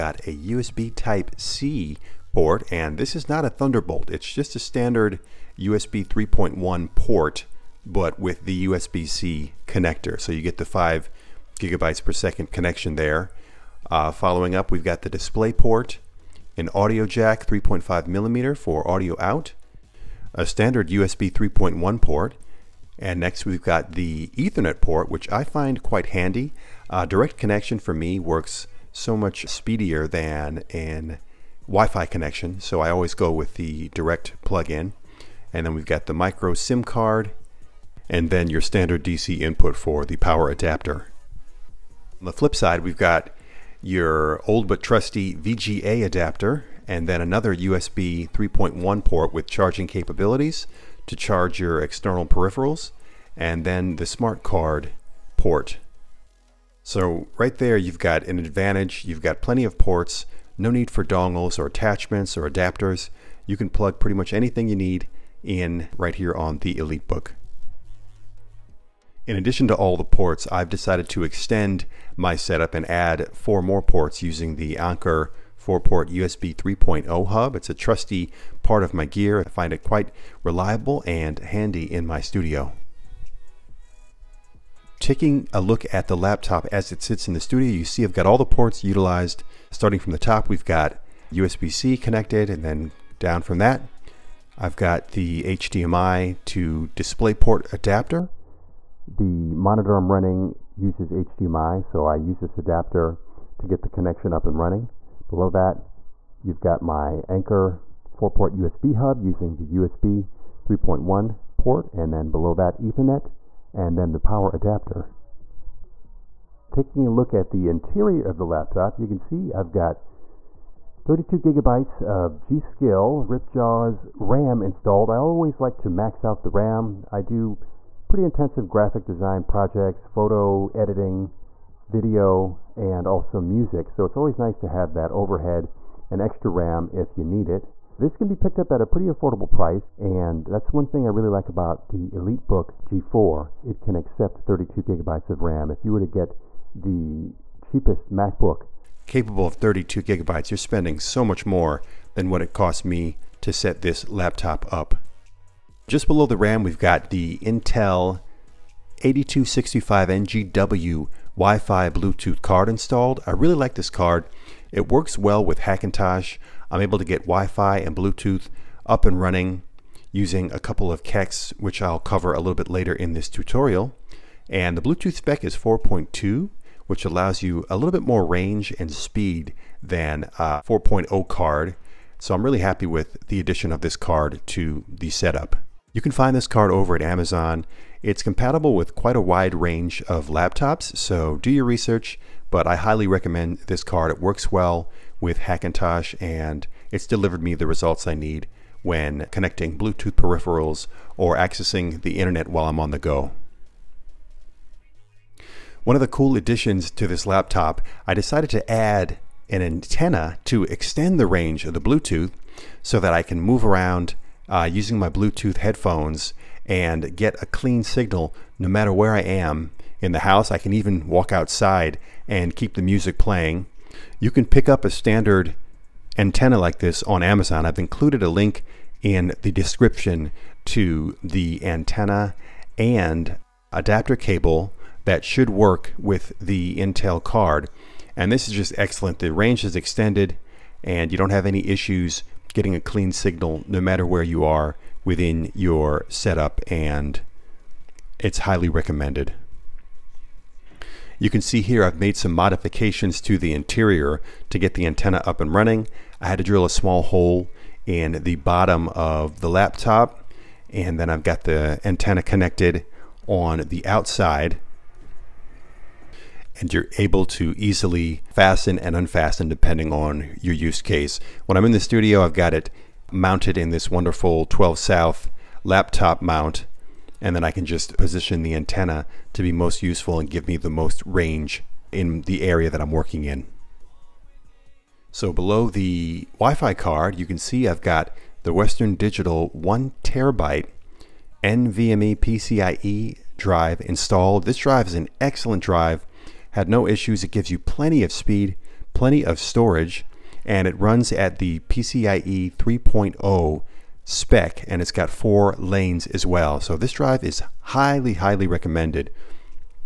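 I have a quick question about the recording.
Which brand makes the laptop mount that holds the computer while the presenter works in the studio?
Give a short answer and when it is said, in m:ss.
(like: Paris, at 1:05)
12 South, at 4:34.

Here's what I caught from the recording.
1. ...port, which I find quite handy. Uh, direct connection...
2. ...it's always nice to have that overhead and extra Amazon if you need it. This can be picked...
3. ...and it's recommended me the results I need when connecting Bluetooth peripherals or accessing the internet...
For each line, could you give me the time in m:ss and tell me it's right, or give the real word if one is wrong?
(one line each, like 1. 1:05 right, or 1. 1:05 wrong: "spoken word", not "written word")
1. 0:24 right
2. 2:14 wrong: "RAM", not "Amazon"
3. 3:16 wrong: "delivered", not "recommended".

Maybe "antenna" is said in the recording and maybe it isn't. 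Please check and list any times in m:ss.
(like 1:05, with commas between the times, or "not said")
3:29, 3:46, 3:51, 4:14, 4:21, 4:38.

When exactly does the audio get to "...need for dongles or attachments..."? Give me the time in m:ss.
1:00.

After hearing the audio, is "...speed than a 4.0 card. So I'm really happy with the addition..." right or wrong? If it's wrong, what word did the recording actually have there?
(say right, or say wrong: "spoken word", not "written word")
right.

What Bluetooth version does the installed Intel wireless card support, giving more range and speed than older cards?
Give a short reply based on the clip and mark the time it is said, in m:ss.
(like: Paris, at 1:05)
4.2, at 2:55.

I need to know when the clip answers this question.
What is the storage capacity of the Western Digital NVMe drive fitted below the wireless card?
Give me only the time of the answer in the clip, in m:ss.
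4:49.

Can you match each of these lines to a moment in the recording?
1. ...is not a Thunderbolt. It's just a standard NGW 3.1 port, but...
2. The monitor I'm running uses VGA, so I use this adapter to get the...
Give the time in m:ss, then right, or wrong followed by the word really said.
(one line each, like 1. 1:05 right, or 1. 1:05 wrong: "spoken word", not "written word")
1. 0:03 wrong: "USB", not "NGW"
2. 1:39 wrong: "HDMI", not "VGA".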